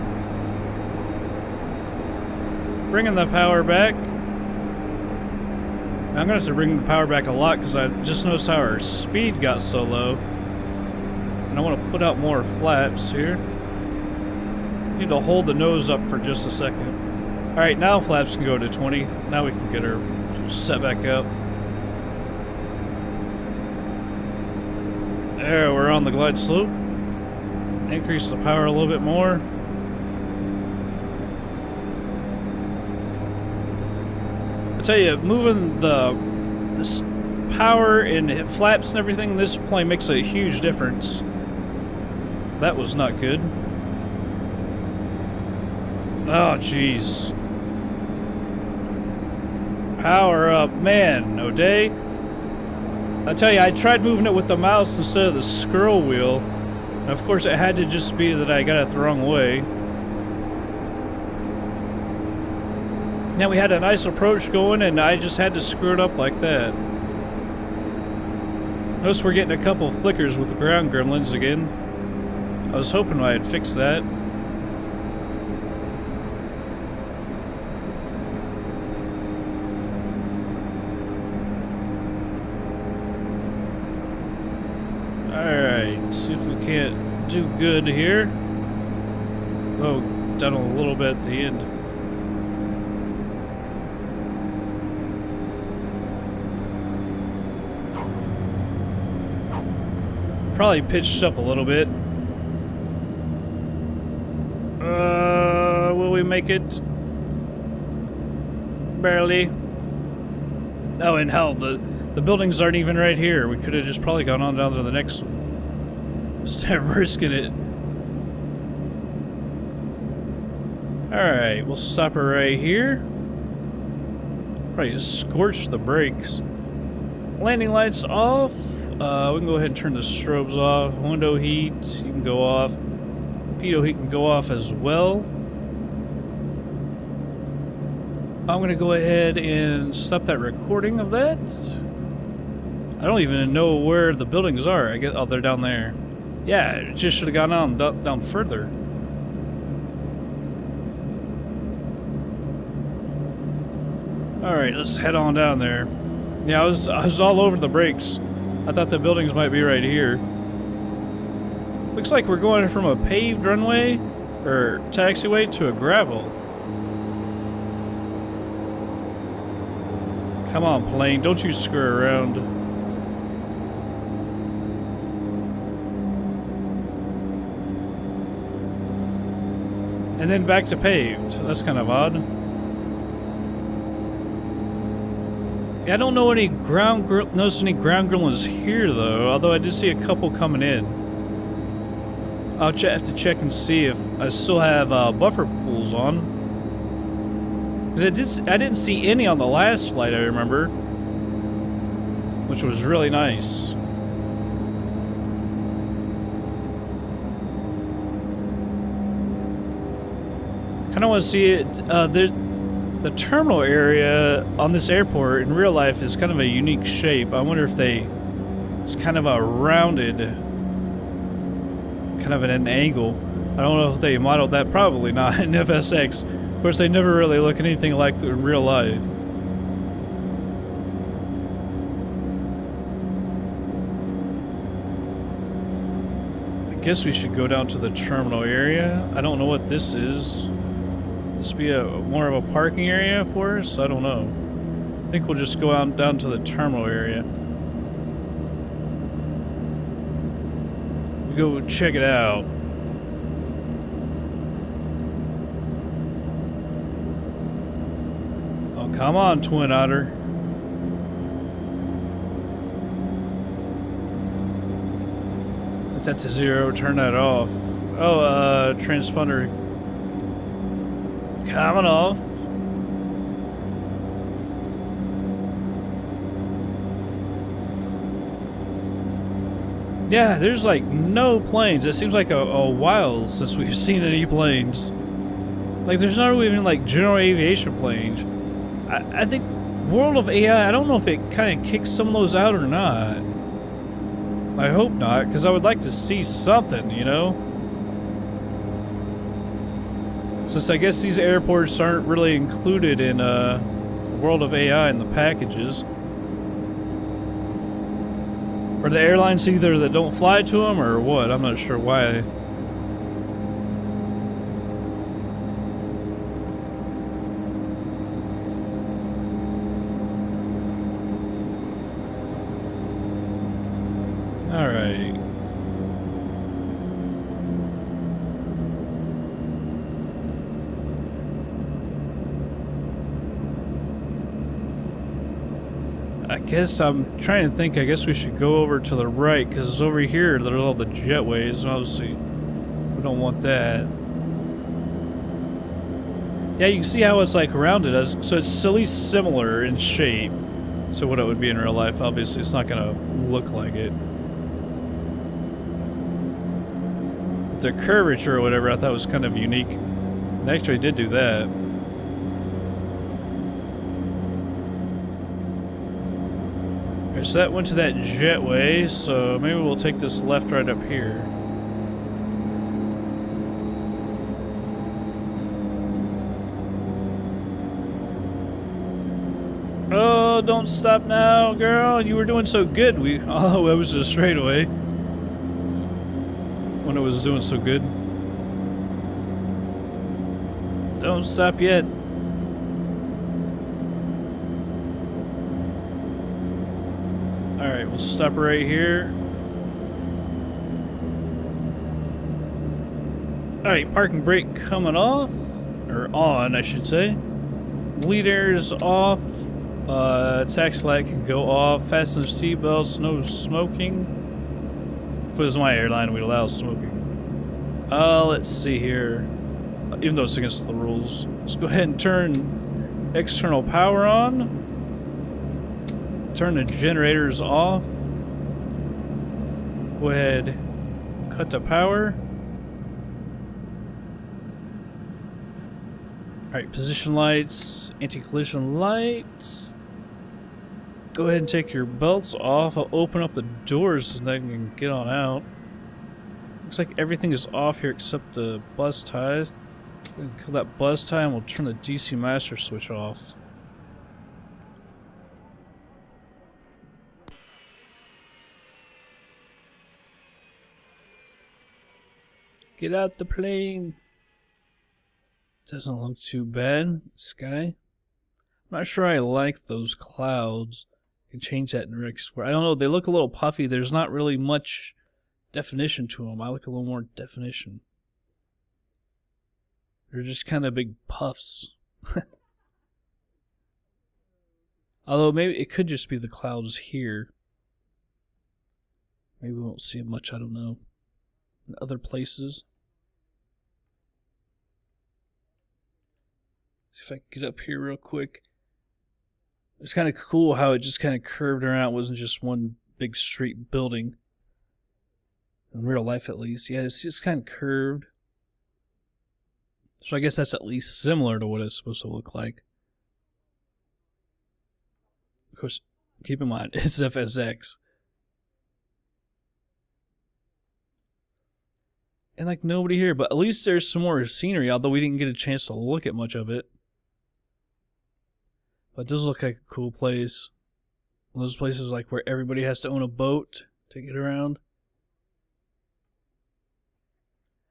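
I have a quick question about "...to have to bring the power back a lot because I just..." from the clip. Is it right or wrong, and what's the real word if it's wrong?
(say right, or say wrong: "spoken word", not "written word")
right.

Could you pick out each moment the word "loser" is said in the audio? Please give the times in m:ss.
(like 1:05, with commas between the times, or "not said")
not said.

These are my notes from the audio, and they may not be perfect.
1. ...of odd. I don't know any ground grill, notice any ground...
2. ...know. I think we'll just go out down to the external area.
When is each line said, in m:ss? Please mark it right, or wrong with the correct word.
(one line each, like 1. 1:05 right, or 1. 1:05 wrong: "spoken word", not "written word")
1. 3:01 right
2. 4:04 wrong: "terminal", not "external".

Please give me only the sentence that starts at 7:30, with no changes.
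Kill that bus tie and we'll turn the DC master switch off.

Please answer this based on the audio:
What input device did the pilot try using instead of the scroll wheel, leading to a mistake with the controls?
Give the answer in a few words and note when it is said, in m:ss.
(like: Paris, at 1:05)
the mouse, at 0:54.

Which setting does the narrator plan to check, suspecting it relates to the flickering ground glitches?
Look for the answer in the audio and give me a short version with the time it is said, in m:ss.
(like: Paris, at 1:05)
buffer pools, at 3:15.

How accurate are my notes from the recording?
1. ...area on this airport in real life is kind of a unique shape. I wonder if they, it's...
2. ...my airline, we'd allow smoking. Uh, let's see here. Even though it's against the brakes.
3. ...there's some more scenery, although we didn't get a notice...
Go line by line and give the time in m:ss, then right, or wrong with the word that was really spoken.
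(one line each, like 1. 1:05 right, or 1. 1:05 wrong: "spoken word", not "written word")
1. 3:33 right
2. 6:55 wrong: "rules", not "brakes"
3. 8:43 wrong: "chance", not "notice".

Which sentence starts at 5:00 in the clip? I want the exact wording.
Since I guess these airports aren't really included in uh, World of AI in the packages.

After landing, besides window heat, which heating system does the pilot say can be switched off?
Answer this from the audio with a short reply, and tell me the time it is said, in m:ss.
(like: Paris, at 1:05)
Pitot heat, at 2:12.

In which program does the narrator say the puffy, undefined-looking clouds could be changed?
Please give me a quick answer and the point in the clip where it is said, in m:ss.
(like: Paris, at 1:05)
REX, at 7:51.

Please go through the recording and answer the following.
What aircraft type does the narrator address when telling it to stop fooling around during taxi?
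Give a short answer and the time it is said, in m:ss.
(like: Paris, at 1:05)
Twin Otter, at 4:19.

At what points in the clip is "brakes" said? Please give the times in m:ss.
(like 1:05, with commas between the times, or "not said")
2:05, 2:37, 6:44.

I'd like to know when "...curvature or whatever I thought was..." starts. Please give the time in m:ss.
5:57.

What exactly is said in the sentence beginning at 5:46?
Yeah, you can see how it's like rounded us.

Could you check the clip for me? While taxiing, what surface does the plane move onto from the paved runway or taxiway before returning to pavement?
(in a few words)
gravel.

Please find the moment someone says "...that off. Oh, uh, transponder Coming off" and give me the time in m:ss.
4:26.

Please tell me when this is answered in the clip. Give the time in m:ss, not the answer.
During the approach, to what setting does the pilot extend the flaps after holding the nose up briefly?
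0:18.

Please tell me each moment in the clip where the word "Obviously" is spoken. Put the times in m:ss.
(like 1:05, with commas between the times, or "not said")
5:41, 5:52.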